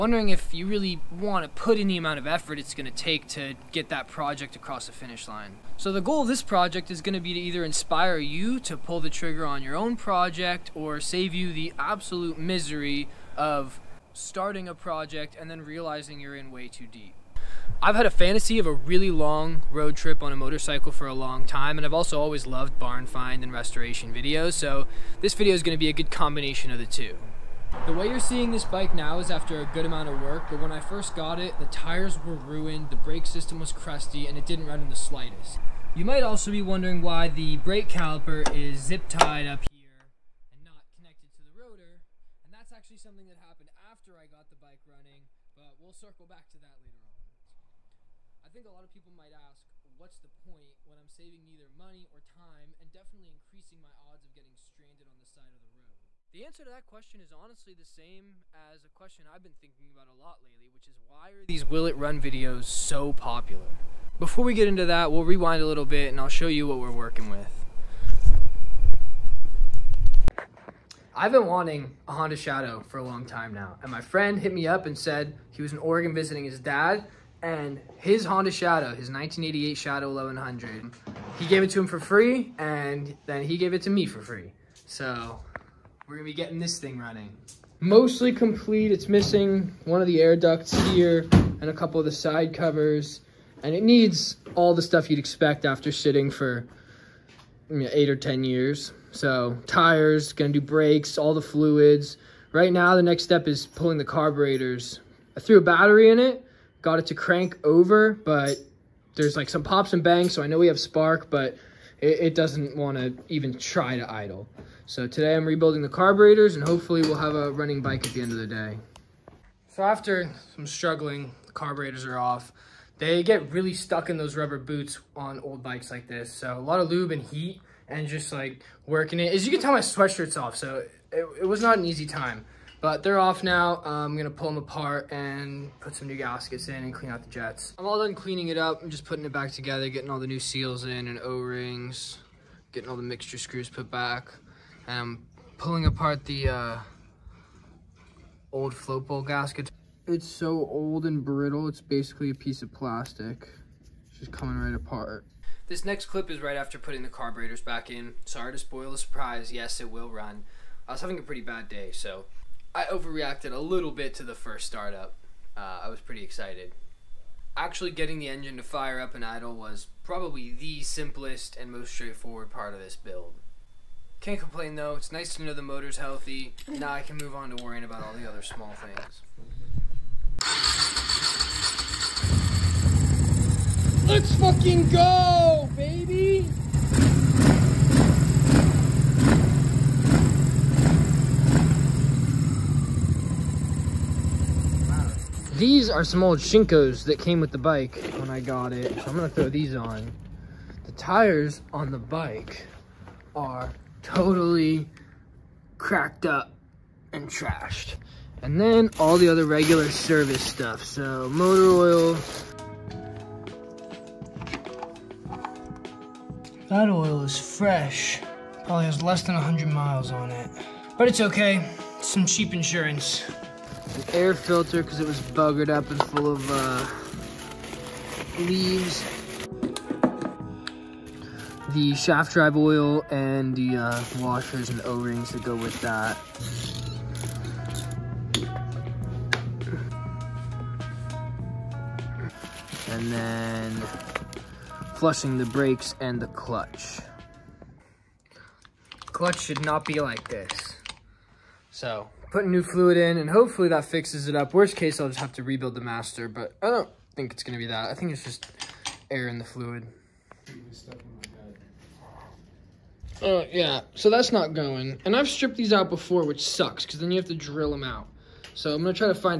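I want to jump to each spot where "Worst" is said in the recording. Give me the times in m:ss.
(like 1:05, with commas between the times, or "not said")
4:14.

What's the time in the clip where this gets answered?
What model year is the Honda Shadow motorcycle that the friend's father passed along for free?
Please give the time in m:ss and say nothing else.
1:19.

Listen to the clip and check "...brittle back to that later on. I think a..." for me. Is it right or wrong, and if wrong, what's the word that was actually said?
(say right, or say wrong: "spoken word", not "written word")
wrong: "circle", not "brittle".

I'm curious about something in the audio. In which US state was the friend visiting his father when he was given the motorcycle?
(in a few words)
Oregon.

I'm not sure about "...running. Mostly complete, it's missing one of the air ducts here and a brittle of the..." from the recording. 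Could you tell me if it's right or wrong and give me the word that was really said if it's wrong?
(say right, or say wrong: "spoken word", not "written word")
wrong: "couple", not "brittle".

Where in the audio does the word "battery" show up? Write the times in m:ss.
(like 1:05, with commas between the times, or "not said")
1:45.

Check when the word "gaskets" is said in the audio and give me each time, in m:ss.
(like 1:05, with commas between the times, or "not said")
2:16, 2:29.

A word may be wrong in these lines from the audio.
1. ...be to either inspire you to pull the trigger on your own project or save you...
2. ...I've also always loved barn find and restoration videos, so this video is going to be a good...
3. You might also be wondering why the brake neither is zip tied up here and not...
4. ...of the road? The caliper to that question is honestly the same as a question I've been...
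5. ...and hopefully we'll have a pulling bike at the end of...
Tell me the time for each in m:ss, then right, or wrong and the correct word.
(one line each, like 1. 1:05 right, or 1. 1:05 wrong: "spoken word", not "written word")
1. 0:07 right
2. 0:21 right
3. 0:35 wrong: "caliper", not "neither"
4. 0:55 wrong: "answer", not "caliper"
5. 1:56 wrong: "running", not "pulling".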